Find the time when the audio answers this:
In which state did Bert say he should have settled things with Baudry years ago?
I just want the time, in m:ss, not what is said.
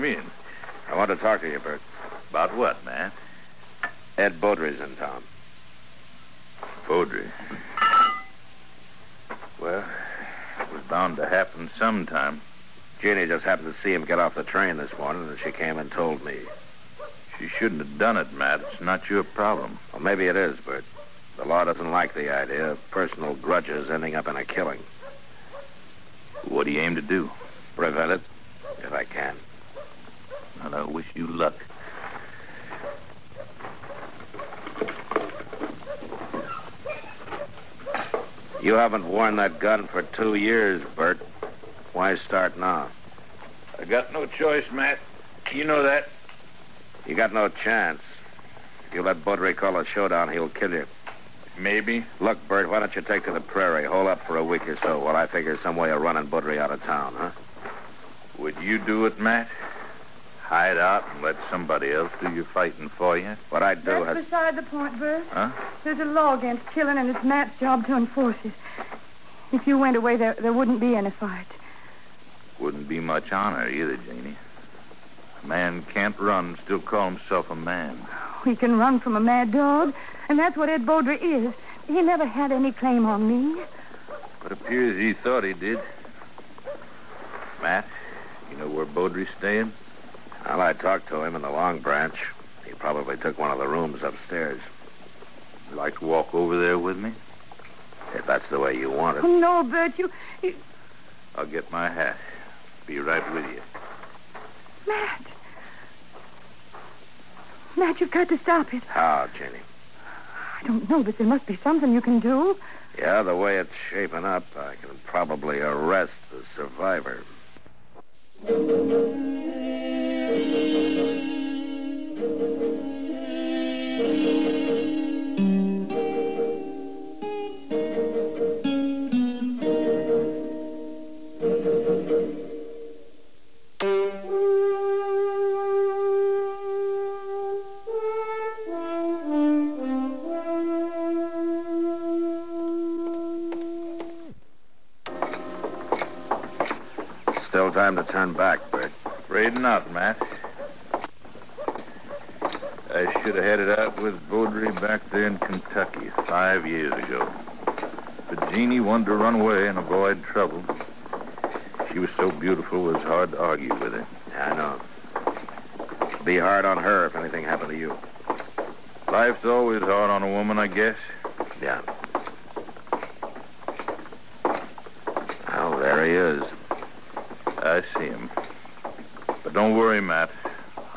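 2:35.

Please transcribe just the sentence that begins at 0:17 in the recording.
She shouldn't have done it, Matt.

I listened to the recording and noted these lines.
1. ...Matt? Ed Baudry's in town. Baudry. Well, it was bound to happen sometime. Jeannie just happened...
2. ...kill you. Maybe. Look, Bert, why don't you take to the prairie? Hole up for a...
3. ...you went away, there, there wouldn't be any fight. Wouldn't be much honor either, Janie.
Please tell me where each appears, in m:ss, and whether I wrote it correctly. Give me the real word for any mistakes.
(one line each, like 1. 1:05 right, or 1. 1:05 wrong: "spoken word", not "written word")
1. 0:02 right
2. 0:50 right
3. 1:09 right.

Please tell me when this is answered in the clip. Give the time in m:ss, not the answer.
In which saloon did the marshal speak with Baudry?
1:31.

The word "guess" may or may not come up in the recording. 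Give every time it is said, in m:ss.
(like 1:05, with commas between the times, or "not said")
2:50.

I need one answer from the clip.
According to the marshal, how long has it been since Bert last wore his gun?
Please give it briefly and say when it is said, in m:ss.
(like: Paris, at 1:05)
2 years, at 0:40.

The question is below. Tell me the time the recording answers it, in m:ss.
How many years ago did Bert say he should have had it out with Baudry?
2:36.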